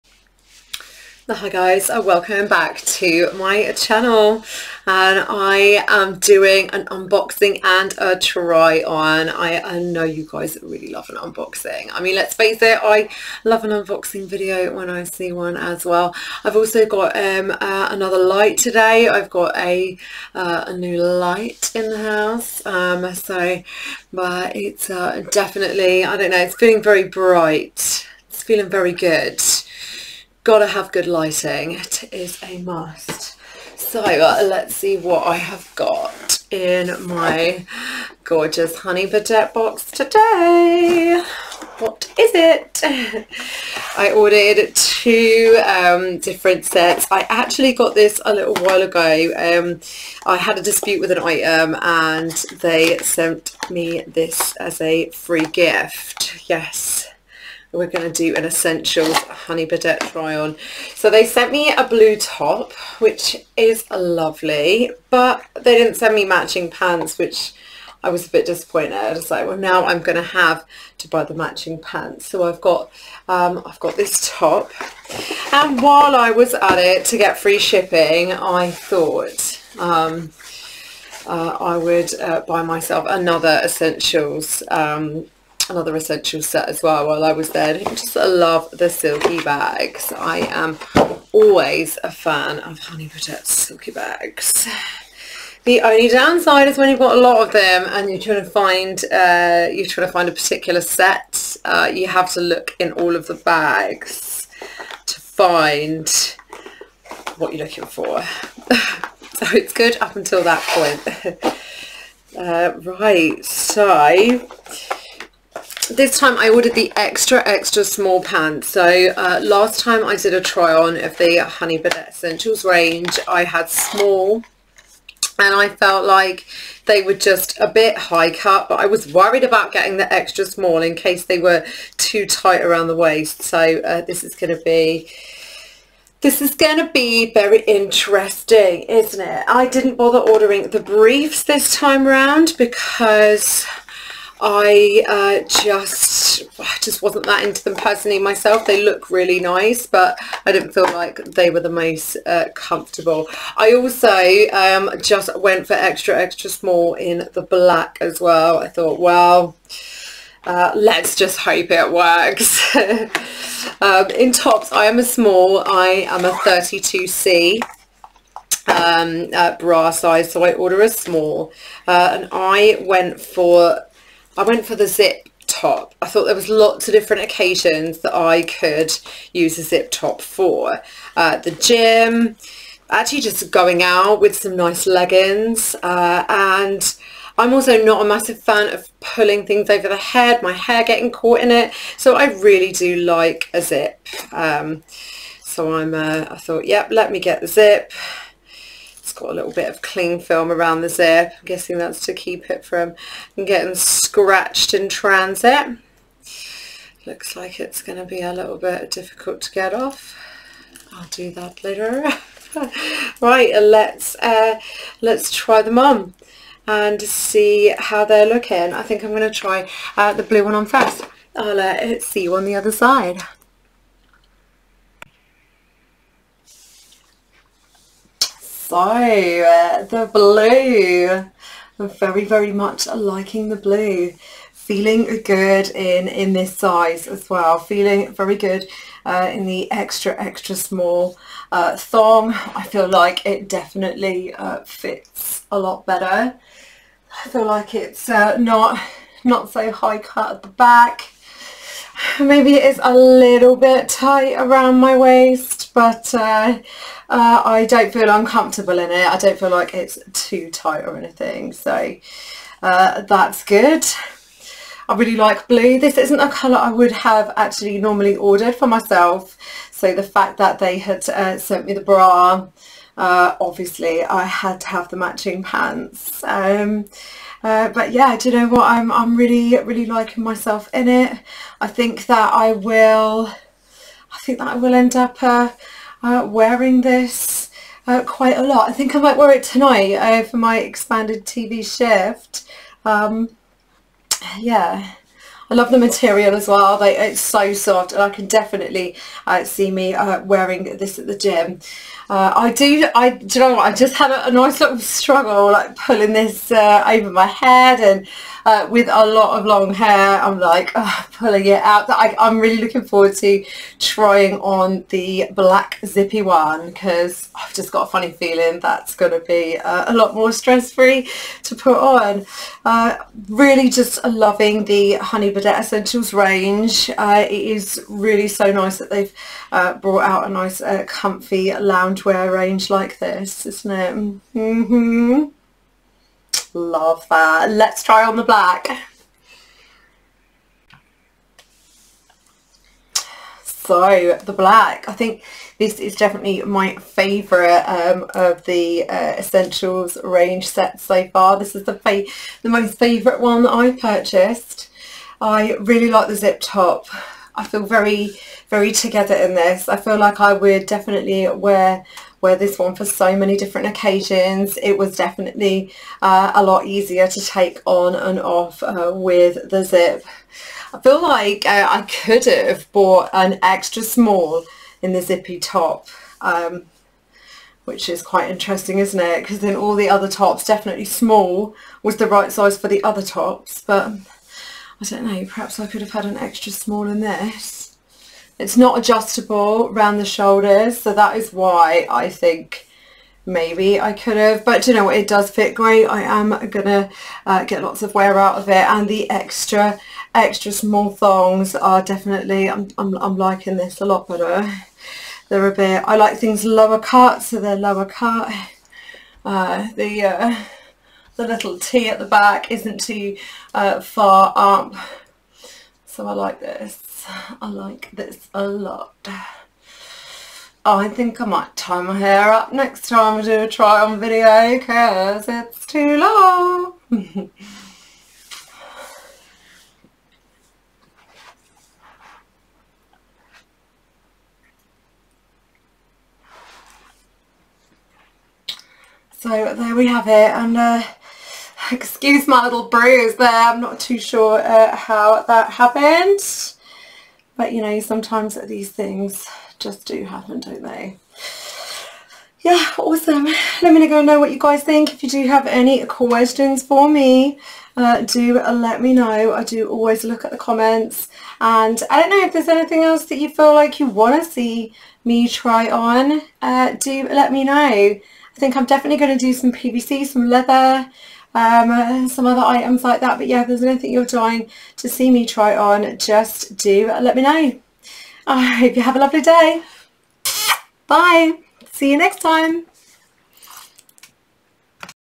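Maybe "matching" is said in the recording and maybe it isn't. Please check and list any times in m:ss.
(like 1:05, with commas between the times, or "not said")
1:06, 1:11, 4:34.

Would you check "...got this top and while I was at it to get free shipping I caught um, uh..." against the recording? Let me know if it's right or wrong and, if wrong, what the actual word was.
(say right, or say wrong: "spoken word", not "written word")
wrong: "thought", not "caught".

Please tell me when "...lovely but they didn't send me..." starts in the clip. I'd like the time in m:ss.
1:03.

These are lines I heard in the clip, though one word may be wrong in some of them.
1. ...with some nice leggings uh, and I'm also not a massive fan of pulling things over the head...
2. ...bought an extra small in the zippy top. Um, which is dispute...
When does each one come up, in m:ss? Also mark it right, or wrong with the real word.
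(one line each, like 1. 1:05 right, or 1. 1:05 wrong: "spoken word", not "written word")
1. 3:04 right
2. 6:12 wrong: "quite", not "dispute".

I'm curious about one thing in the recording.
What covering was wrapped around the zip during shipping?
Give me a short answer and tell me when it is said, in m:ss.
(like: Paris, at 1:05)
Cling film, at 3:19.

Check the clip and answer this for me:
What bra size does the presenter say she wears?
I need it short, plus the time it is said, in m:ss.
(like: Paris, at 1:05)
32C, at 2:46.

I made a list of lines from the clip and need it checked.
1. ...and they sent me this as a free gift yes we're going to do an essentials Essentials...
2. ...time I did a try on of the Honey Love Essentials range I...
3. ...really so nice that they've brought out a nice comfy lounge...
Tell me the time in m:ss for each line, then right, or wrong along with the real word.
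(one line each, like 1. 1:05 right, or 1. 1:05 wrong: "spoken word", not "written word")
1. 0:51 wrong: "Honey", not "Essentials"
2. 1:59 wrong: "Birdette", not "Love"
3. 5:27 right.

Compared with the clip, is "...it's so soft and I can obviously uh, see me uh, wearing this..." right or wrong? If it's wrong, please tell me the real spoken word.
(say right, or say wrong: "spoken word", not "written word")
wrong: "definitely", not "obviously".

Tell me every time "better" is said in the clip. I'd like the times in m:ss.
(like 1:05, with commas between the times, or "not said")
4:05, 6:44.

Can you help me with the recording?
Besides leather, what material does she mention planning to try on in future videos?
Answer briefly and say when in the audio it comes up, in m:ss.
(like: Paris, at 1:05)
PVC, at 7:49.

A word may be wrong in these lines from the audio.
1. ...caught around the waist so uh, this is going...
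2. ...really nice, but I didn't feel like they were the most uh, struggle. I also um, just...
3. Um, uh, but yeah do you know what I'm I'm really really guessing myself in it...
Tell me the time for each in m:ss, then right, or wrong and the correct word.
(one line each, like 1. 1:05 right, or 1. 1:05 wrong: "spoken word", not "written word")
1. 2:12 wrong: "tight", not "caught"
2. 2:29 wrong: "comfortable", not "struggle"
3. 4:36 wrong: "liking", not "guessing".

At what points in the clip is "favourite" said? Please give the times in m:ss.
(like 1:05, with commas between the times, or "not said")
5:46, 5:52.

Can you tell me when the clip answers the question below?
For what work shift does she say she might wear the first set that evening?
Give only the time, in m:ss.
4:50.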